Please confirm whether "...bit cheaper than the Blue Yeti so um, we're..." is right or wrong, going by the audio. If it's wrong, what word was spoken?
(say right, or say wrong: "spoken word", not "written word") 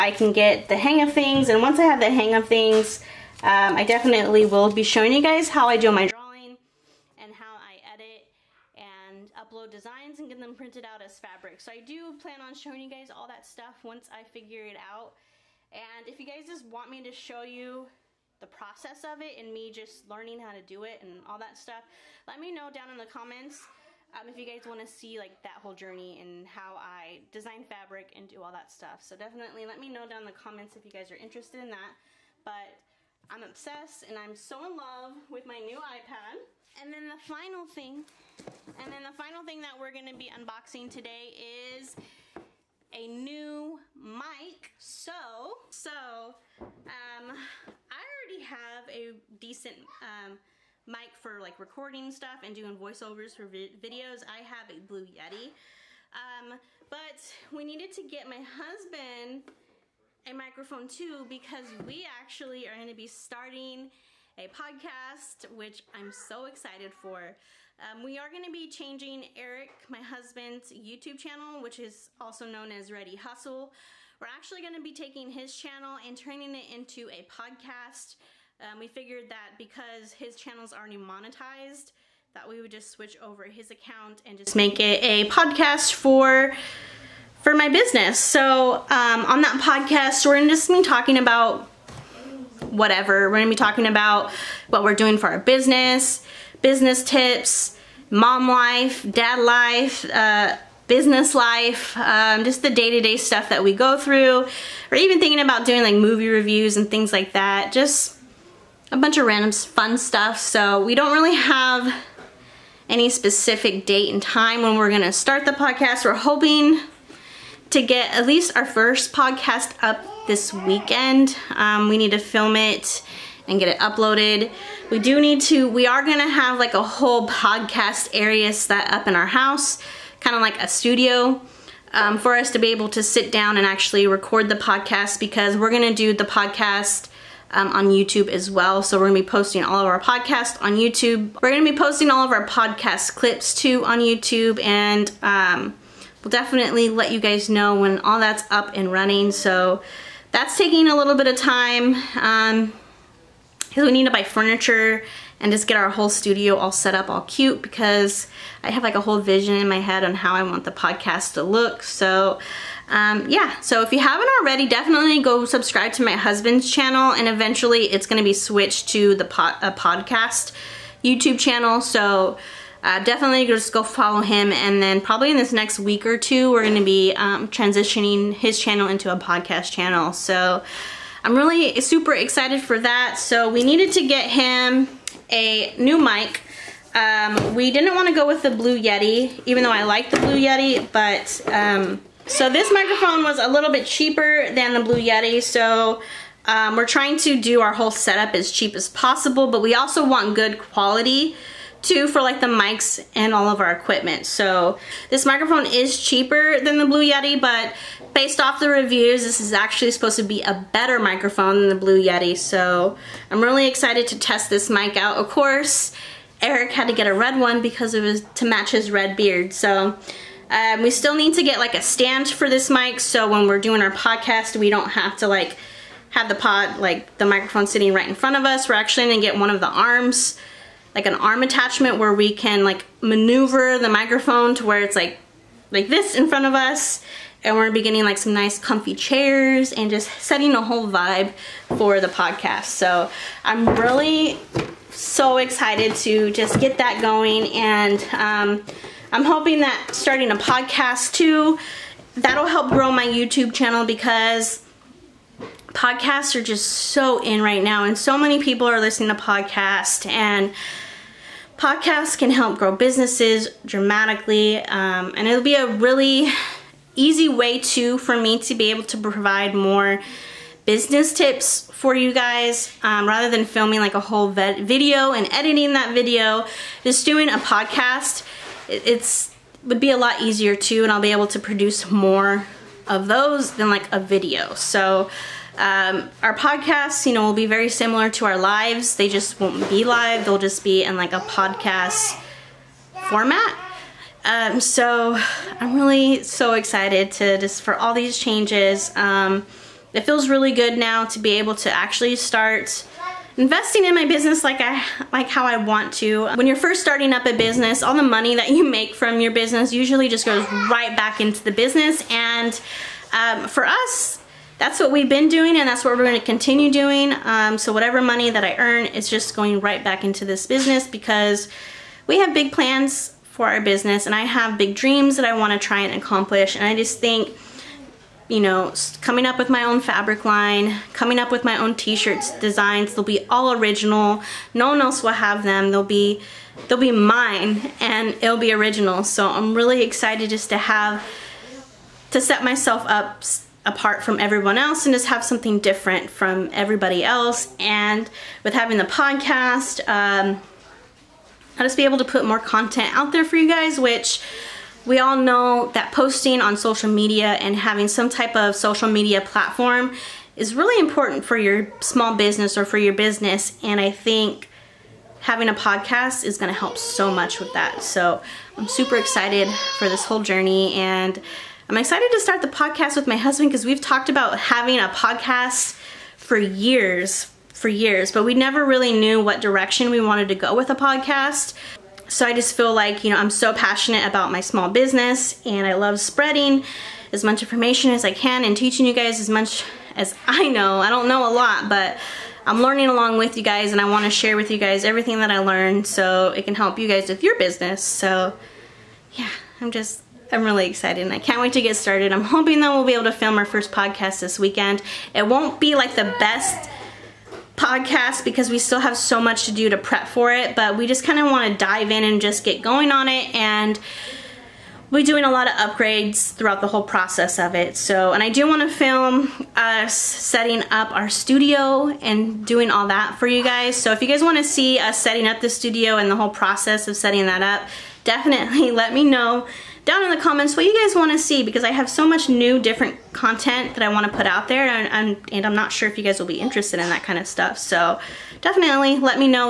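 right.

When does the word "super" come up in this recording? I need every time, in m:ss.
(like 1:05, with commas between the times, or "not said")
3:01, 6:08.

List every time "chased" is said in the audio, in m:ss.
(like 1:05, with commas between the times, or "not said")
not said.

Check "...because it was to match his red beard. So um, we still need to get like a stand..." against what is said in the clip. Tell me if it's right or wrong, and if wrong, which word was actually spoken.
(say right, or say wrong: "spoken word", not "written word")
right.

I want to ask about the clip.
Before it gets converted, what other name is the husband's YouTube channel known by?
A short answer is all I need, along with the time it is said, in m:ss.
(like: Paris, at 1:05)
Ready Hustle, at 1:12.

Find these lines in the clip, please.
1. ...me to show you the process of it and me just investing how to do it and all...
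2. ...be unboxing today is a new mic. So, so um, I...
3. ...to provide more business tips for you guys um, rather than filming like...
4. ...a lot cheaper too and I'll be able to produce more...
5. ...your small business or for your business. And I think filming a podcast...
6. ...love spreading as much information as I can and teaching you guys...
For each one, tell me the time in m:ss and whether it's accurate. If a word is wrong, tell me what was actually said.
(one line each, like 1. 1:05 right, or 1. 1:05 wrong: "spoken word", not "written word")
1. 0:16 wrong: "learning", not "investing"
2. 0:40 right
3. 4:28 right
4. 4:39 wrong: "easier", not "cheaper"
5. 6:01 wrong: "having", not "filming"
6. 6:25 right.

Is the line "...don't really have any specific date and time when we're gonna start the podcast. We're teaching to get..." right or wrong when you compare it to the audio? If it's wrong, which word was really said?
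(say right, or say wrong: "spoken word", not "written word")
wrong: "hoping", not "teaching".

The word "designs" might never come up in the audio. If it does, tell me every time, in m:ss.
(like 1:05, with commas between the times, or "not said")
0:09, 0:27, 5:32.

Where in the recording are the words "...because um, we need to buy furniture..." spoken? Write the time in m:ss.
2:31.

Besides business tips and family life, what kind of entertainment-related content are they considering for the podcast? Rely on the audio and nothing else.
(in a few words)
Movie reviews.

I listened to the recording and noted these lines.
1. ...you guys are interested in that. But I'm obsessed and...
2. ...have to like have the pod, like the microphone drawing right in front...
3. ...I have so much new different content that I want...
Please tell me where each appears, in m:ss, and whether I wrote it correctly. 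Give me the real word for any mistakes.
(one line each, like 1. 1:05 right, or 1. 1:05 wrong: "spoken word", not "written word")
1. 0:30 right
2. 3:44 wrong: "sitting", not "drawing"
3. 7:11 right.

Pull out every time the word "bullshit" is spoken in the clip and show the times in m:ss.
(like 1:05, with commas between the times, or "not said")
not said.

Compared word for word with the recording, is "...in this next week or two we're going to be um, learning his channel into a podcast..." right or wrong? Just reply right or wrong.
wrong.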